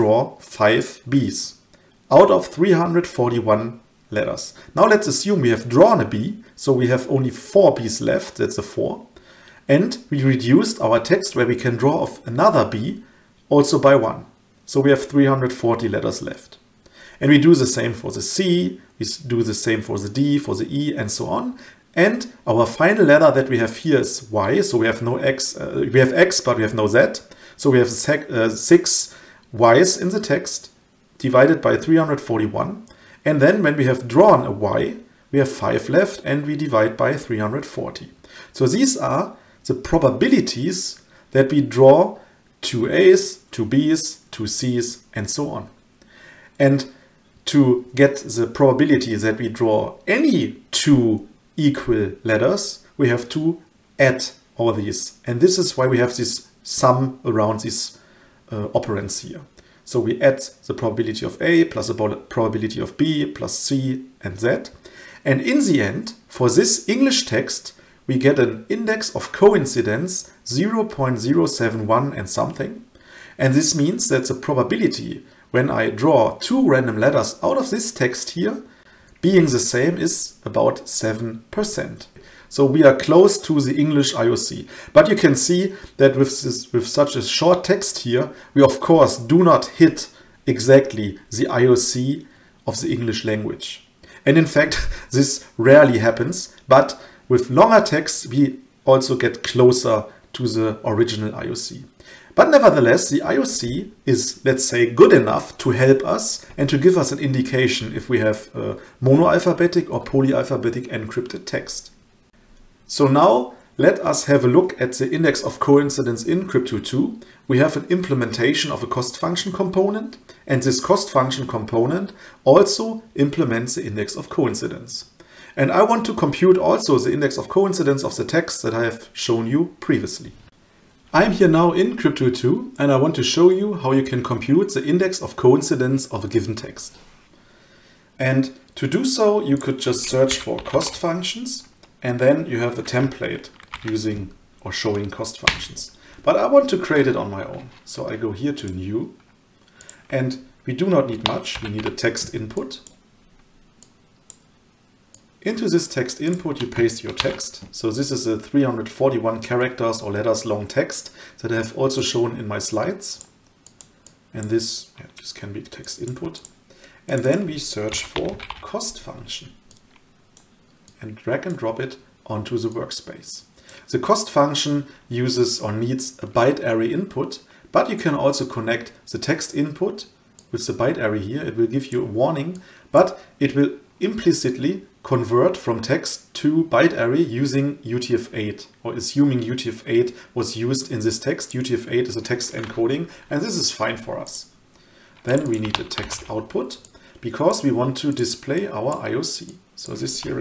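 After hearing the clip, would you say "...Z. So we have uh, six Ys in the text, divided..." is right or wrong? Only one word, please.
right.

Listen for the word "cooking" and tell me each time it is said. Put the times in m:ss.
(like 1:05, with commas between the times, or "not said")
not said.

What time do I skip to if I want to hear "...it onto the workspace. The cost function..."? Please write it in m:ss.
2:51.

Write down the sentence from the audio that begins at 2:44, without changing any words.
And this, yeah, this can be text input.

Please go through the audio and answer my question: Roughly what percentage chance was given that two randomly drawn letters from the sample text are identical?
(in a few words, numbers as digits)
7%.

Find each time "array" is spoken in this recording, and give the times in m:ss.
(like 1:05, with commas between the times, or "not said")
2:56, 3:00, 3:06.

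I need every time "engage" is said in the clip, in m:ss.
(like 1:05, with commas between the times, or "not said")
not said.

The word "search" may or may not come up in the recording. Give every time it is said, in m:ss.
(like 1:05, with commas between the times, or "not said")
2:20, 2:47.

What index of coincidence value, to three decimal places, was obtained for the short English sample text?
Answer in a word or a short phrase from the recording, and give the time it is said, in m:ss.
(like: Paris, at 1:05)
0.071, at 1:10.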